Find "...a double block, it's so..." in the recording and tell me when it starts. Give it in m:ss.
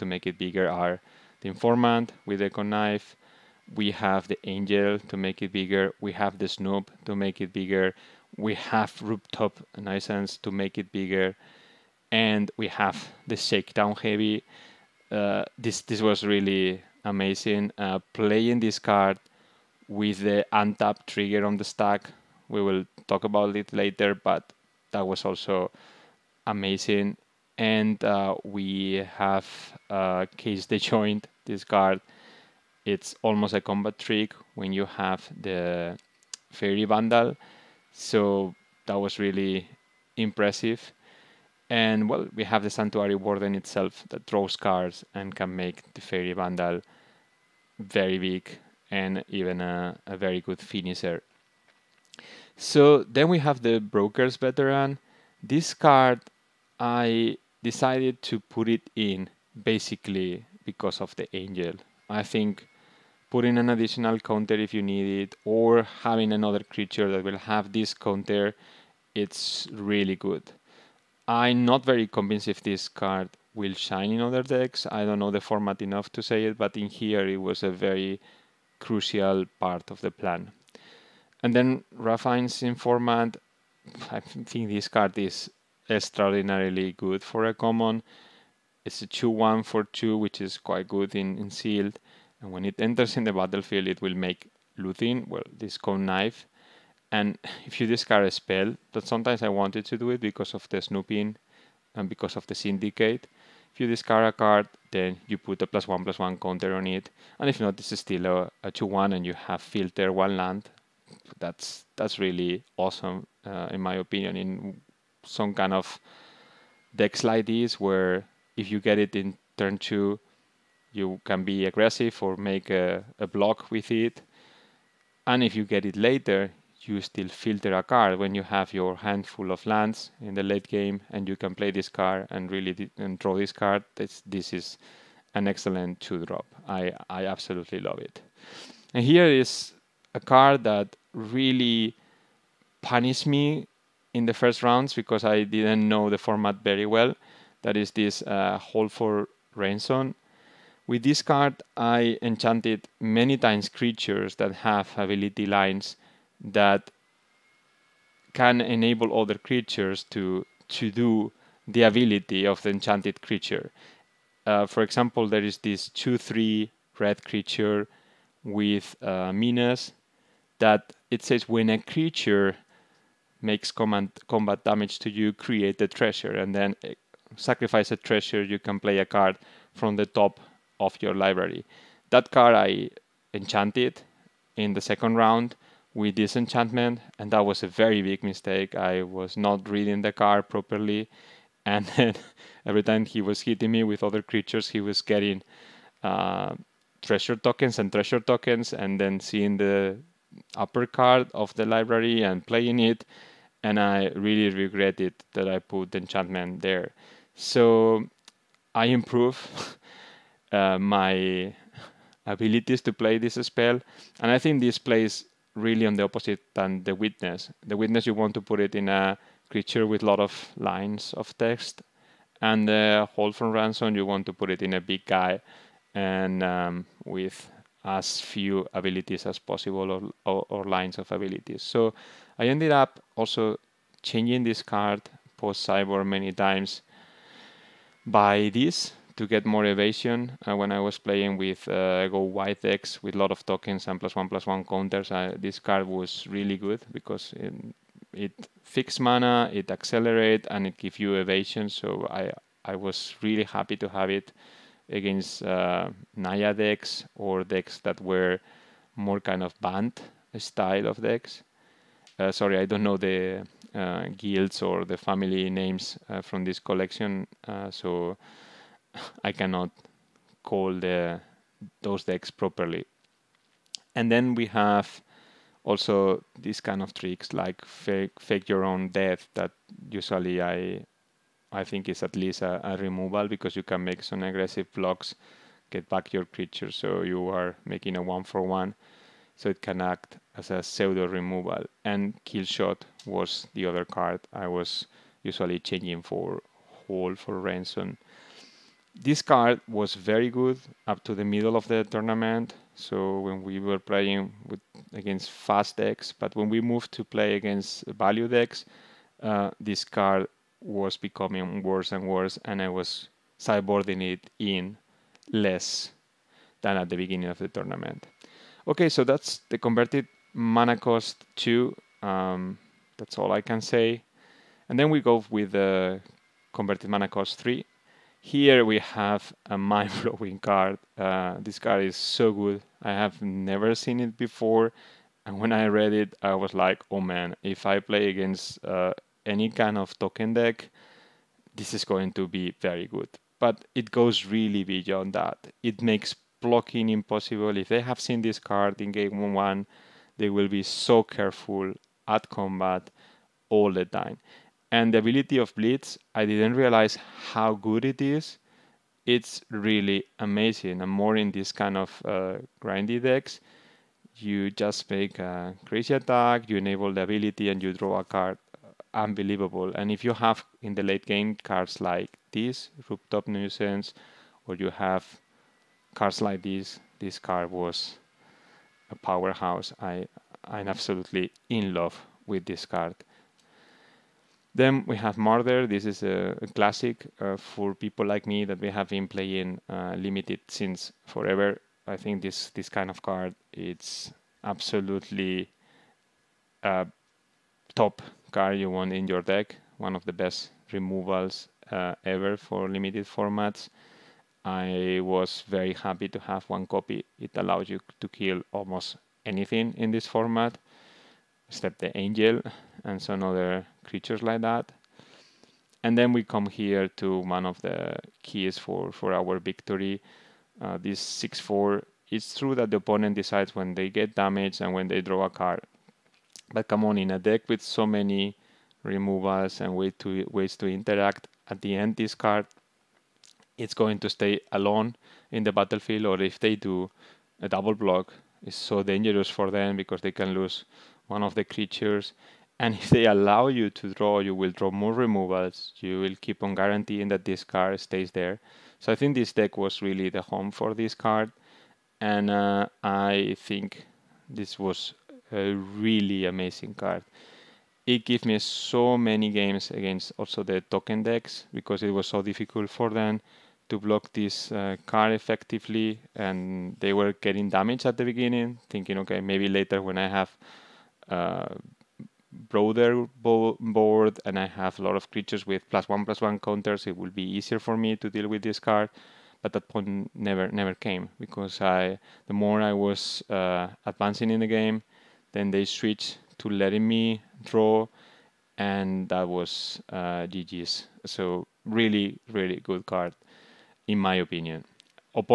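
7:17.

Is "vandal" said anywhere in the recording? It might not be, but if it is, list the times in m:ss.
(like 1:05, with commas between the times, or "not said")
0:36, 0:46.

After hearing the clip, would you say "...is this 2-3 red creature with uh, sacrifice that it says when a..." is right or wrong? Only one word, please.
wrong.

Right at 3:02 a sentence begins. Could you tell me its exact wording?
That card I enchanted in the second round with disenchantment, and that was a very big mistake.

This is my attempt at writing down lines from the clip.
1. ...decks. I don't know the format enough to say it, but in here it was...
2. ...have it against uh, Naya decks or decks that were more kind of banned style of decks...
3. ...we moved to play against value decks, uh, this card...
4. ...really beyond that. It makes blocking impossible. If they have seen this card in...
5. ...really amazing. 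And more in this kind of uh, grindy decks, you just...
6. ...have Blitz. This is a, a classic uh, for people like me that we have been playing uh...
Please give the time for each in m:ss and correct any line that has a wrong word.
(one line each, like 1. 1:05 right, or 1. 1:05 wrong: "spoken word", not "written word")
1. 1:14 right
2. 4:13 right
3. 5:06 right
4. 5:44 right
5. 5:59 right
6. 6:24 wrong: "Murder", not "Blitz".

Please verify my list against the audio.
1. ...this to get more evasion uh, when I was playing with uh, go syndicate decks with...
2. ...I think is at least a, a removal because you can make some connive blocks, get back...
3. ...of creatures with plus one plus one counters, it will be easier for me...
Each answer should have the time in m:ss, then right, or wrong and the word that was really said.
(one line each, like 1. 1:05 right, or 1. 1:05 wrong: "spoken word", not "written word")
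1. 3:58 wrong: "white", not "syndicate"
2. 4:41 wrong: "aggressive", not "connive"
3. 7:54 right.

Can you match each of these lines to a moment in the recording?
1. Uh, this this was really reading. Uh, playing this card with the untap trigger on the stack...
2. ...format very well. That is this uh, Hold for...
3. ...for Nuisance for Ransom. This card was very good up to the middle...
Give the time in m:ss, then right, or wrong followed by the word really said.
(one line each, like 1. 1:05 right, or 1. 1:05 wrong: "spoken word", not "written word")
1. 0:15 wrong: "amazing", not "reading"
2. 2:26 right
3. 4:56 wrong: "Hold", not "Nuisance".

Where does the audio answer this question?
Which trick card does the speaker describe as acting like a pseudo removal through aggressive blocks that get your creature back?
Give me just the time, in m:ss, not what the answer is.
4:38.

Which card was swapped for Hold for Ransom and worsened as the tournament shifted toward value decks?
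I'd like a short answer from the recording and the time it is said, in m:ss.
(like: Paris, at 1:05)
Kill Shot, at 4:52.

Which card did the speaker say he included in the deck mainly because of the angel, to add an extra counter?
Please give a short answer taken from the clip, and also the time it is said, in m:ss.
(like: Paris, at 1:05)
Broker's Veteran, at 0:53.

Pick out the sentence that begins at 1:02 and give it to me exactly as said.
I think putting an additional counter if you need it or having another creature that will have this counter, it's really good.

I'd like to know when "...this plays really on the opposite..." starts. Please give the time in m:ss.
3:34.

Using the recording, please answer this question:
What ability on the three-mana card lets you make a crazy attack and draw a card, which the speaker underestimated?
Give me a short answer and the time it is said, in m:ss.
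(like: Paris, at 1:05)
Blitz, at 5:55.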